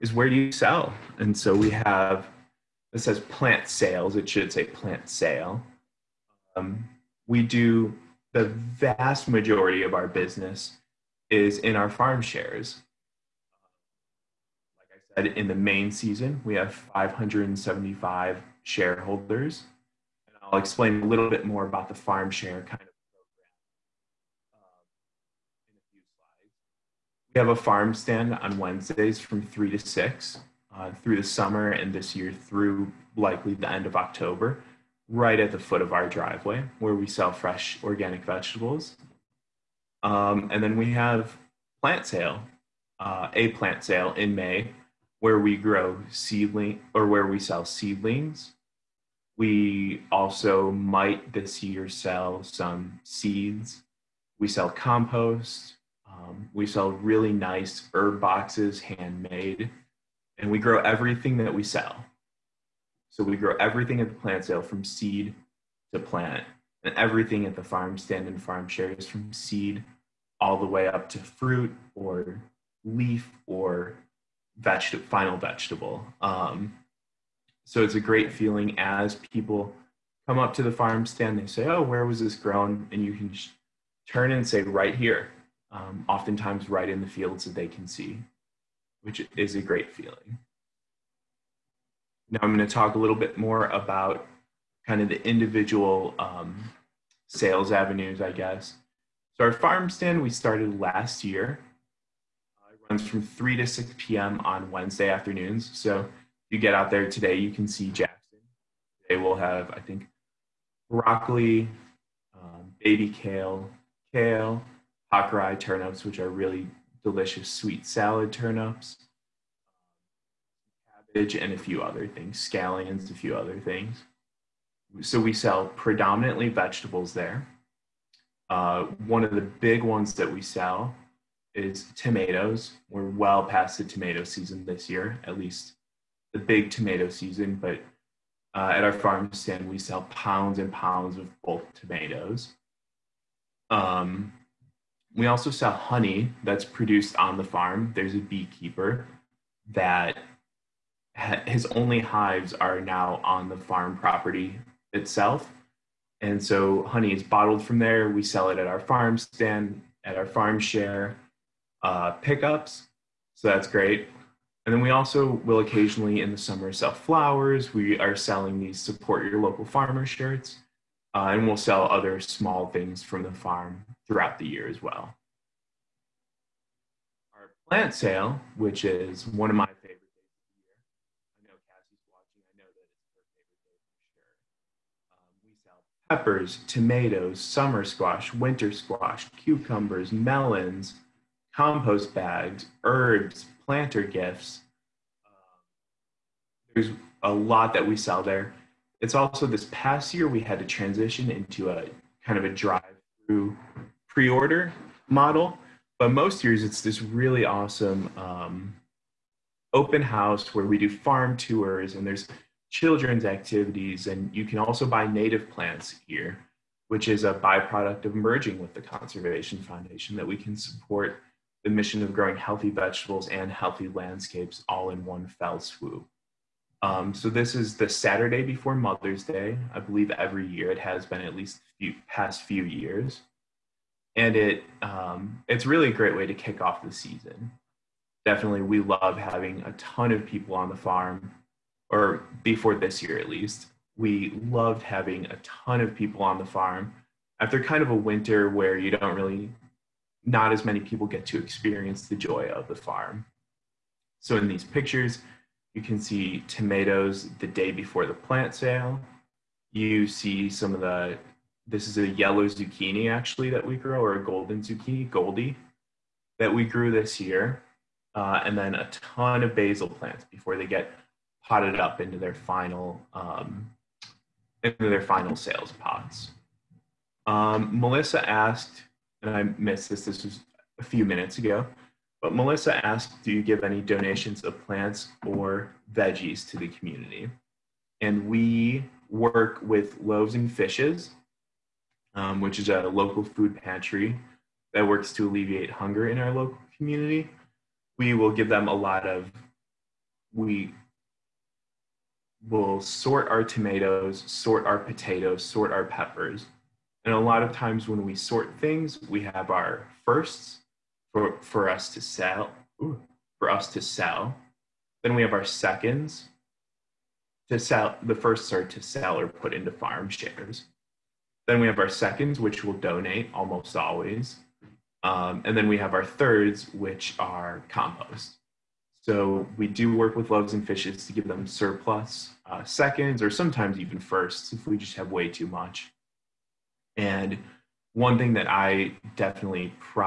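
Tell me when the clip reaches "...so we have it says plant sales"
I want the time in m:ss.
0:01.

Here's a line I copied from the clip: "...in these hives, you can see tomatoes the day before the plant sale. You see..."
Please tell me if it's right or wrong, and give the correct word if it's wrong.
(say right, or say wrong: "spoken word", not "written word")
wrong: "pictures", not "hives".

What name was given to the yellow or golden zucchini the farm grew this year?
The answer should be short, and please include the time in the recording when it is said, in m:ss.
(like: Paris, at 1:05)
Goldie, at 4:25.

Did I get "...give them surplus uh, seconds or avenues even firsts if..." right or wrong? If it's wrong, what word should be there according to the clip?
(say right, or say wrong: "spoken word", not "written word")
wrong: "sometimes", not "avenues".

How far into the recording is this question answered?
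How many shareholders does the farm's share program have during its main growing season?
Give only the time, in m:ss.
0:16.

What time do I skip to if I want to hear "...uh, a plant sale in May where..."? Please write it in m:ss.
0:42.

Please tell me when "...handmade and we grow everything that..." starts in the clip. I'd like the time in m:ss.
0:58.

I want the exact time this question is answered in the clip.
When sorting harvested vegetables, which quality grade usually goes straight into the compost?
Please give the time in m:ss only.
5:26.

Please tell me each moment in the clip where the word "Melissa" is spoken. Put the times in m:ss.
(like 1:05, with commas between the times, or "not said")
4:37, 4:42.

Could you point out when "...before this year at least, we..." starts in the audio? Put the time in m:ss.
4:02.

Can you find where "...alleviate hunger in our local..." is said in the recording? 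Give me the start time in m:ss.
4:55.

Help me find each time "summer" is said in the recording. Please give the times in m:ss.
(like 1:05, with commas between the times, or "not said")
0:31, 2:46, 3:07.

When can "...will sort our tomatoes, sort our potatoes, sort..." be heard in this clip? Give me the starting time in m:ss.
5:02.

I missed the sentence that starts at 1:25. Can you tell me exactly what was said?
Um, oftentimes, right in the fields that they can see which is a great feeling.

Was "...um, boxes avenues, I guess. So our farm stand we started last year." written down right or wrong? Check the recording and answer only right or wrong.
wrong.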